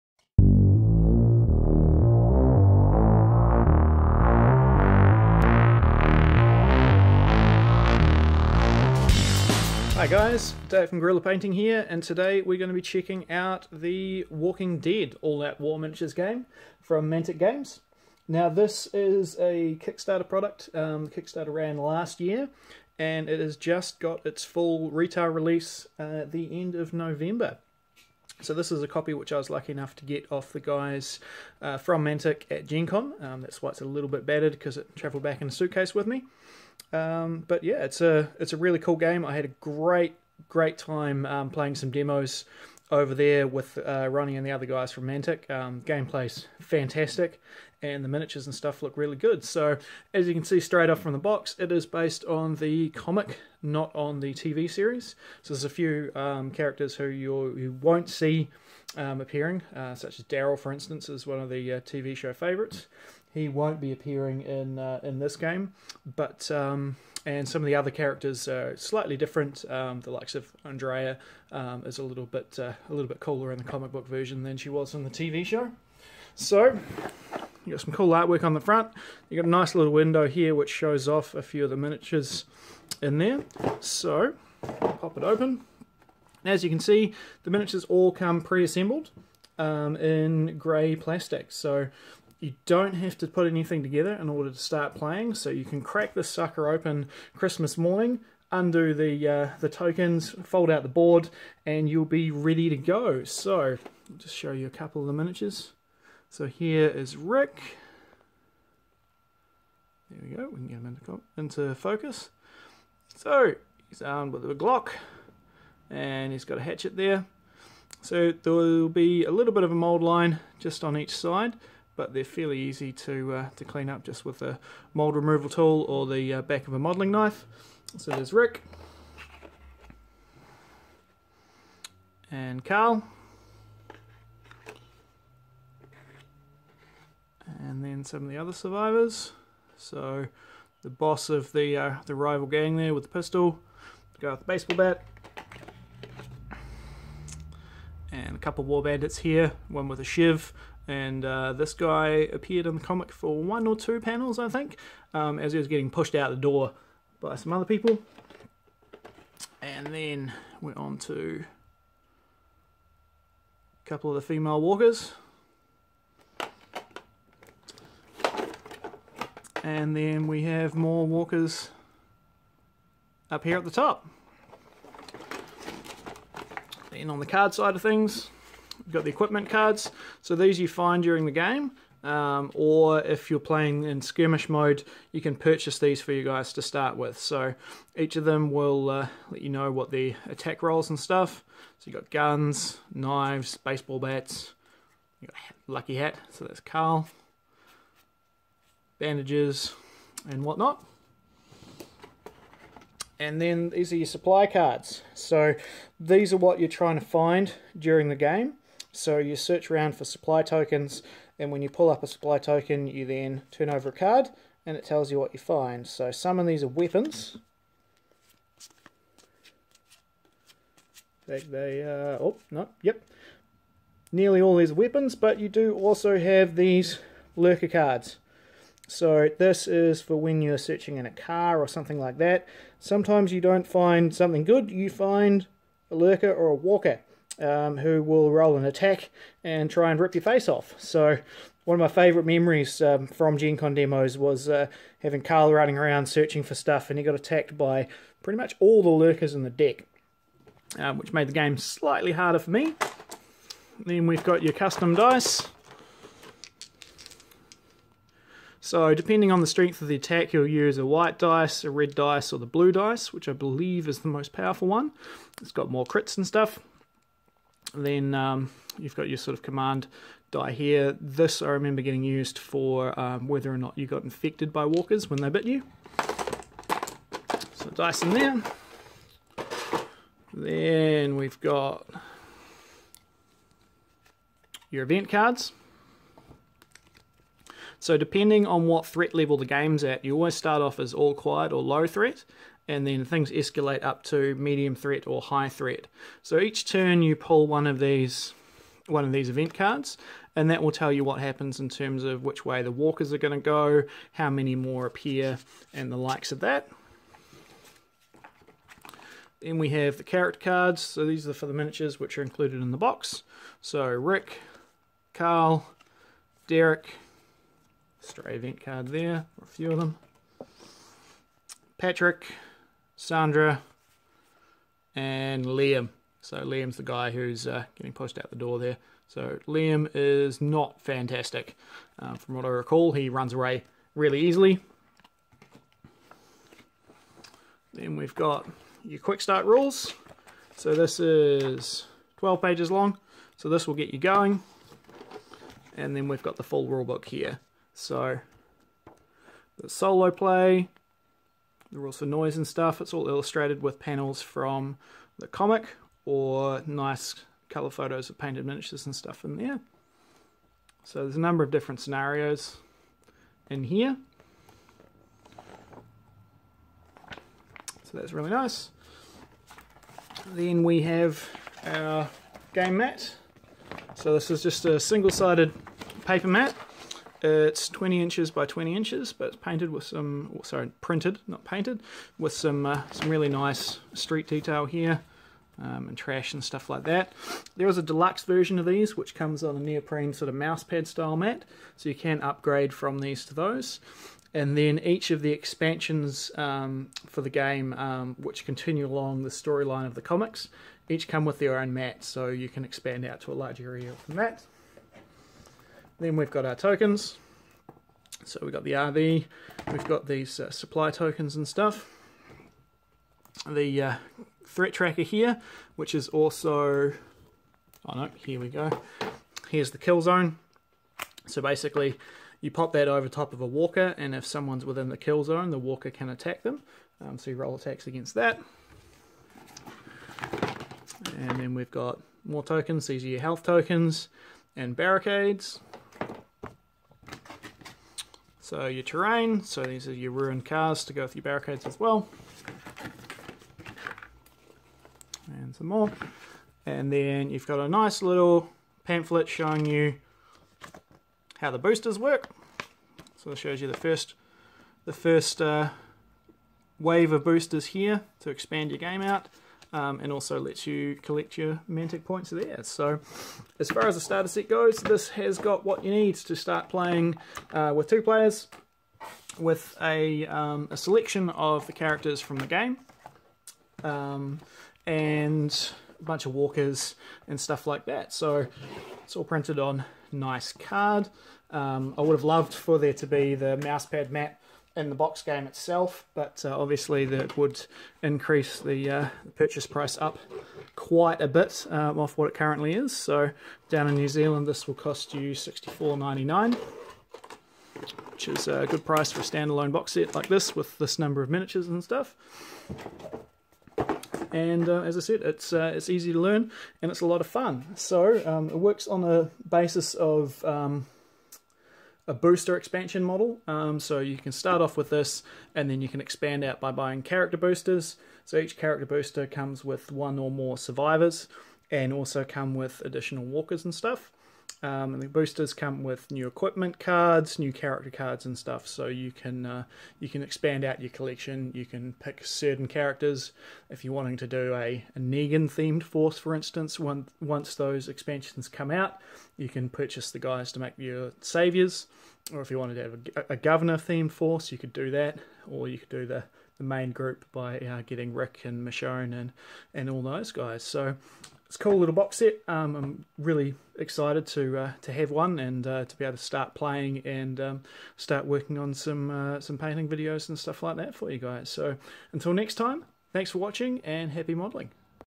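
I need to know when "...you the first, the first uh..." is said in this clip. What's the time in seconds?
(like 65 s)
453 s.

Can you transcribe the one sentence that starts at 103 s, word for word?
So, I'll just show you a couple of the miniatures.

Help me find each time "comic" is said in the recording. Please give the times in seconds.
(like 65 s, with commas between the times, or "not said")
52 s, 73 s, 152 s, 355 s, 400 s.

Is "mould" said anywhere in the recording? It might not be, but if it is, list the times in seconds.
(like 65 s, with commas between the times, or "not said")
119 s, 124 s.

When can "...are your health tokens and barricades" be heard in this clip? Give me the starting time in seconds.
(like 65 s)
433 s.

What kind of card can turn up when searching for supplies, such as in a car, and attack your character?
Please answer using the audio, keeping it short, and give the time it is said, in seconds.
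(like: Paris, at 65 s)
lurker cards, at 227 s.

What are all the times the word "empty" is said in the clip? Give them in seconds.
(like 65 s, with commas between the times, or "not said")
not said.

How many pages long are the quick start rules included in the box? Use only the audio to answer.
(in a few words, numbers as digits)
12.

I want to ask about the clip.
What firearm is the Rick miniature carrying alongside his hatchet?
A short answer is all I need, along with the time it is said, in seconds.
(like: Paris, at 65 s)
Glock, at 114 s.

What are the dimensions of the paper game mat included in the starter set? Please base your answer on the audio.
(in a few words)
20 inches by 20 inches.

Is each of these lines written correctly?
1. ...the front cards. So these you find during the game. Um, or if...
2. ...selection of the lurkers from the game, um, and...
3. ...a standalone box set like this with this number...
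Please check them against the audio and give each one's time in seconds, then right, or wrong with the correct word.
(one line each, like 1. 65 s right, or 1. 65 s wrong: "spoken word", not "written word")
1. 179 s wrong: "equipment", not "front"
2. 470 s wrong: "characters", not "lurkers"
3. 499 s right.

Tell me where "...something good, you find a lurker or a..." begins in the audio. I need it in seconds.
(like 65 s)
234 s.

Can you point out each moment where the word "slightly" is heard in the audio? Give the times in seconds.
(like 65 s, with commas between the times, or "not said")
68 s, 251 s.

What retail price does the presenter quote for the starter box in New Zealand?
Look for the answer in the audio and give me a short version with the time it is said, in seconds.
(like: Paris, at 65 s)
$64.99, at 495 s.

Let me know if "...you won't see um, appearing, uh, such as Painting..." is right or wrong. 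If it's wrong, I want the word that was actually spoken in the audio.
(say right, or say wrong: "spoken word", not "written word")
wrong: "Daryl", not "Painting".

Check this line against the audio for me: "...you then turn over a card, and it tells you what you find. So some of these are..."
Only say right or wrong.
right.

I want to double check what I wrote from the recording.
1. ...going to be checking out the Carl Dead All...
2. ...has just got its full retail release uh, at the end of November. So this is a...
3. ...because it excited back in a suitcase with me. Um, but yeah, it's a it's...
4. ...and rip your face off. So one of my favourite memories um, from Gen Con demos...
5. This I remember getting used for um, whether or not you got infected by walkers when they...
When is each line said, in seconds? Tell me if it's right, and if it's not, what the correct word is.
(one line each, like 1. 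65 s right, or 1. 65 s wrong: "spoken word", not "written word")
1. 12 s wrong: "Walking", not "Carl"
2. 23 s right
3. 34 s wrong: "travelled", not "excited"
4. 239 s right
5. 270 s right.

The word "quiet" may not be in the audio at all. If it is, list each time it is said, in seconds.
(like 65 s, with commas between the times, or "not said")
291 s.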